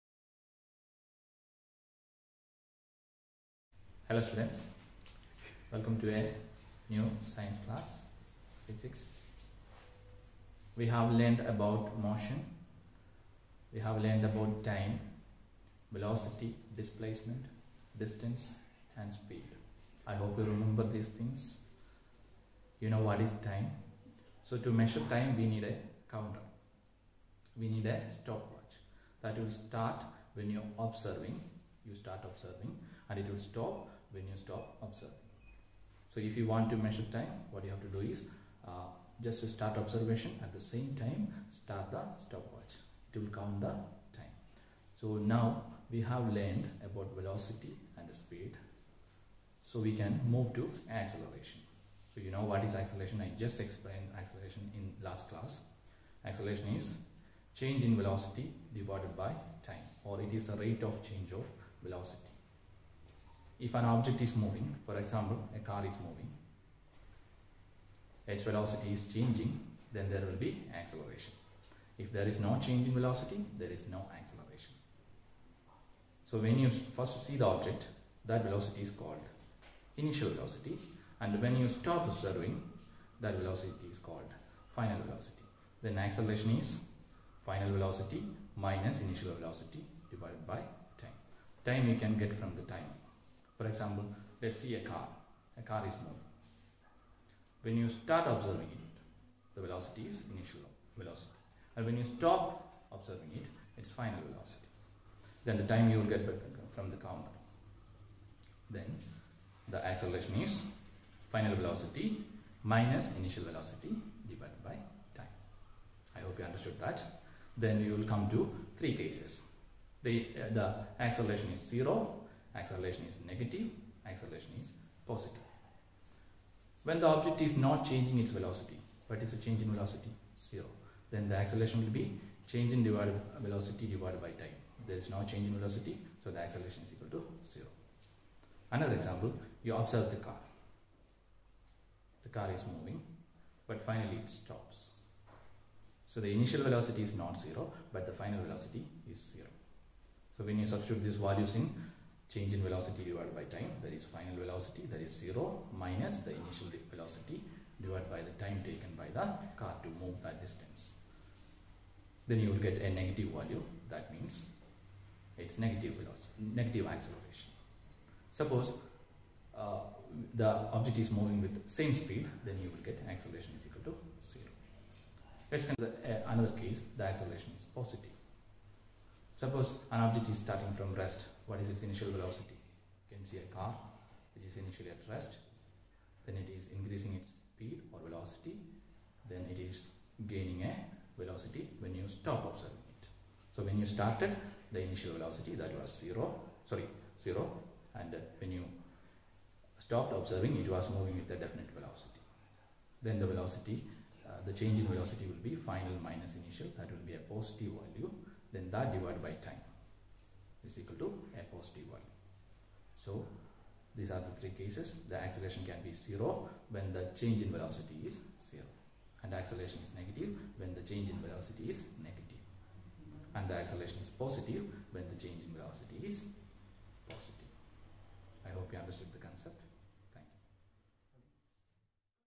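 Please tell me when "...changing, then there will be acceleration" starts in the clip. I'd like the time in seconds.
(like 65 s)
69 s.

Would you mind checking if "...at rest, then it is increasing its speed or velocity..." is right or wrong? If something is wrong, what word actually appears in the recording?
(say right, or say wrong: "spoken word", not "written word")
right.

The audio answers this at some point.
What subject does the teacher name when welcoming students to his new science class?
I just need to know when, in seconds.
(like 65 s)
8 s.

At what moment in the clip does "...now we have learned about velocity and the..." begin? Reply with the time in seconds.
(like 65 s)
45 s.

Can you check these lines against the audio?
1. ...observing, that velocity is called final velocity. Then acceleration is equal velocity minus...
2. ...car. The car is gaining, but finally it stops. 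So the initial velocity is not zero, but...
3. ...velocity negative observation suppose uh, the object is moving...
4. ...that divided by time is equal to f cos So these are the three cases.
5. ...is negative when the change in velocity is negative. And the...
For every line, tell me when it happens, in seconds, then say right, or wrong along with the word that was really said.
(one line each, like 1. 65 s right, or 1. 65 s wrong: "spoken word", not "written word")
1. 82 s wrong: "final", not "equal"
2. 140 s wrong: "moving", not "gaining"
3. 165 s wrong: "acceleration", not "observation"
4. 208 s right
5. 219 s right.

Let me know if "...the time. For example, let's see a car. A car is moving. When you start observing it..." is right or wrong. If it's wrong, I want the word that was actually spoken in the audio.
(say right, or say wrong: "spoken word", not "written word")
right.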